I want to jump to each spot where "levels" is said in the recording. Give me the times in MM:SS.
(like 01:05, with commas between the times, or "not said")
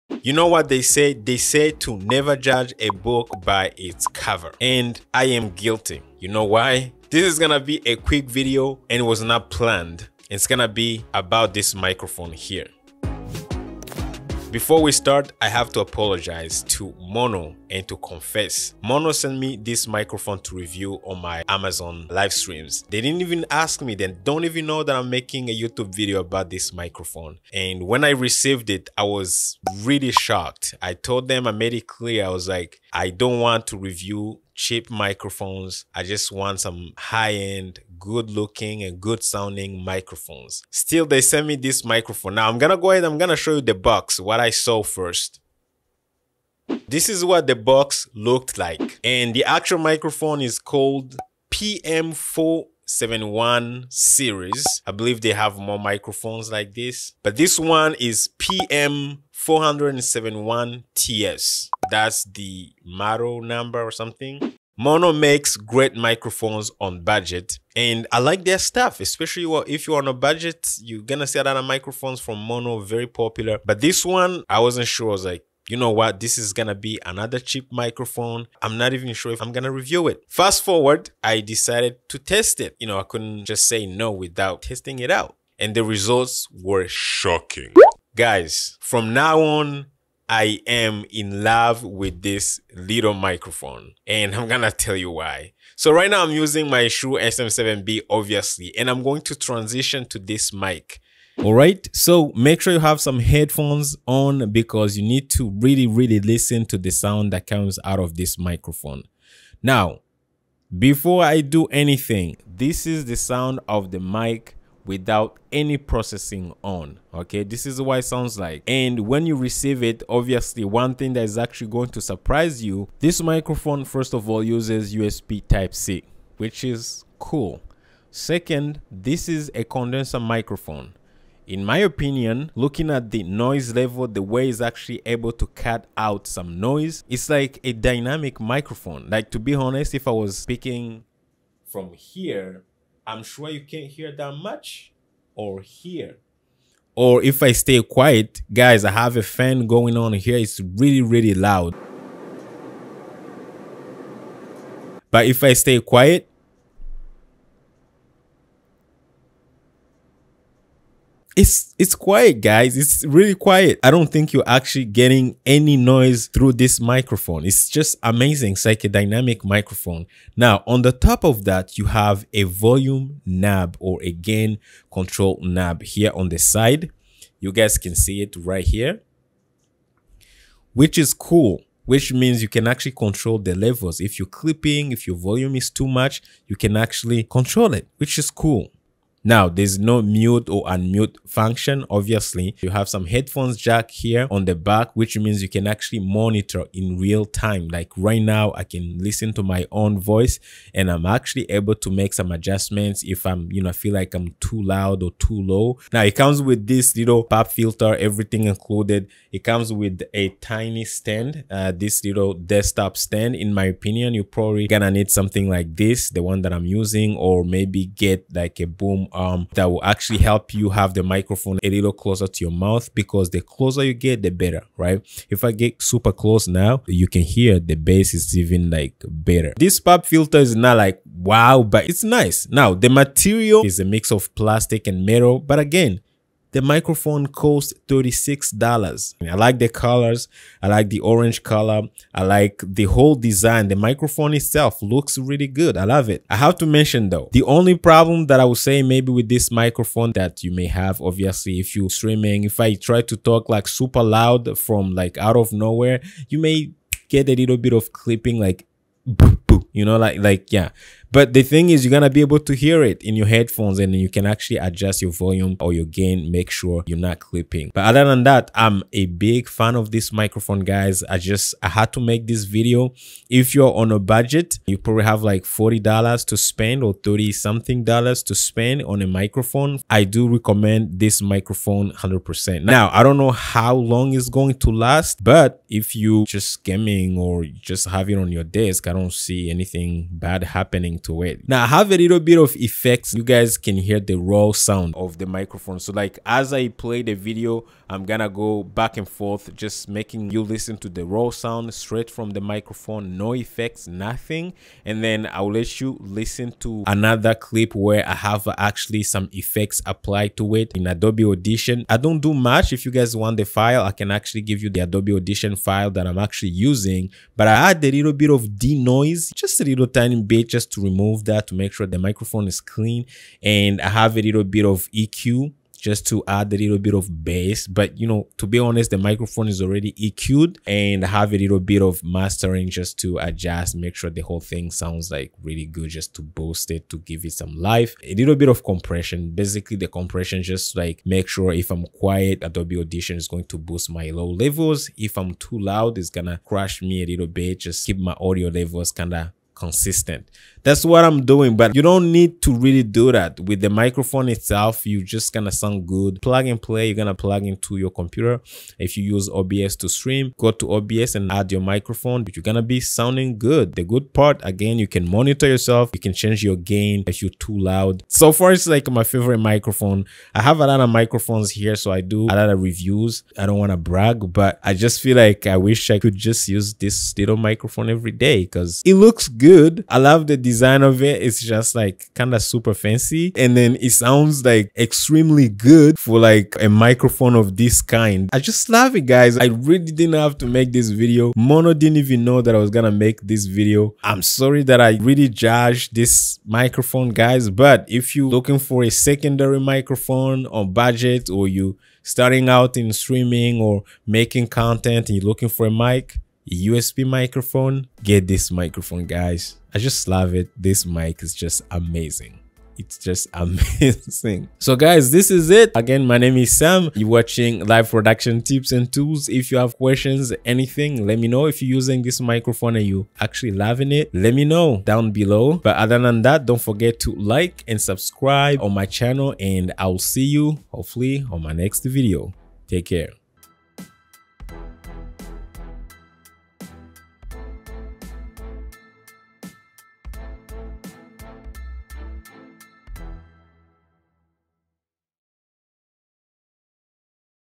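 02:13, 03:03, 05:44, 05:48.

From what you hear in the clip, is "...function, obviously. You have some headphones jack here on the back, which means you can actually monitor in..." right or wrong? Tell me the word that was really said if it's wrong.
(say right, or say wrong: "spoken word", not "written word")
right.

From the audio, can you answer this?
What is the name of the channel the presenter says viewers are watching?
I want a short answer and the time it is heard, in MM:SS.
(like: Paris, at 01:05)
Live Production Tips and Tools, at 06:57.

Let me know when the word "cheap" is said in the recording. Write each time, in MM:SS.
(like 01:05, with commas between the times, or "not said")
00:34, 01:17.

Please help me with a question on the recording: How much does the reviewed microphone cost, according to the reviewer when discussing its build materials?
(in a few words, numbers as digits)
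$36.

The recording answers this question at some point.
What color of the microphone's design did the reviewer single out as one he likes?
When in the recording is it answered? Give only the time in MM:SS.
04:00.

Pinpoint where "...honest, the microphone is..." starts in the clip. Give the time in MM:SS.
05:28.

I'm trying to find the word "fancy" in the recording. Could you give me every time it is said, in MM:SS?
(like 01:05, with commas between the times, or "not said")
06:22.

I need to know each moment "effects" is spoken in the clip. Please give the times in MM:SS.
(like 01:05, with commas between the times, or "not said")
04:52, 05:03, 05:09.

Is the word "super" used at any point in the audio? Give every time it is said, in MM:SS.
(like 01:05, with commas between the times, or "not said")
03:45, 04:13, 06:22.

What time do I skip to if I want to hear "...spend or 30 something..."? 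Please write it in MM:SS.
04:36.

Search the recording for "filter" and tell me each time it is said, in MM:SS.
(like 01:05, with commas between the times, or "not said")
03:27, 03:50.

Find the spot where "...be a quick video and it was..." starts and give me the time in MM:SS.
00:07.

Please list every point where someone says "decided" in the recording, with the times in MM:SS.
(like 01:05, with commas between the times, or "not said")
01:21.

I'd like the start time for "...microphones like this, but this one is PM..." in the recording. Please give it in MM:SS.
00:55.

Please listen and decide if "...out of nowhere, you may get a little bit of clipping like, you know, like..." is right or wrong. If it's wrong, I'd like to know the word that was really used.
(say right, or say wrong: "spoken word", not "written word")
right.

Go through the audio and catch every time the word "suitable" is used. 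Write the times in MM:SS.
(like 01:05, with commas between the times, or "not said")
not said.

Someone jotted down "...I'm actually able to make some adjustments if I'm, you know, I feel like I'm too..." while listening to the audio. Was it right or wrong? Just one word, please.
right.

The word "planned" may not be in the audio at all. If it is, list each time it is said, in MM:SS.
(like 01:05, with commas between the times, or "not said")
00:09.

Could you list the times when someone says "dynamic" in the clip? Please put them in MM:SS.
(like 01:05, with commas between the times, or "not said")
02:17, 02:48.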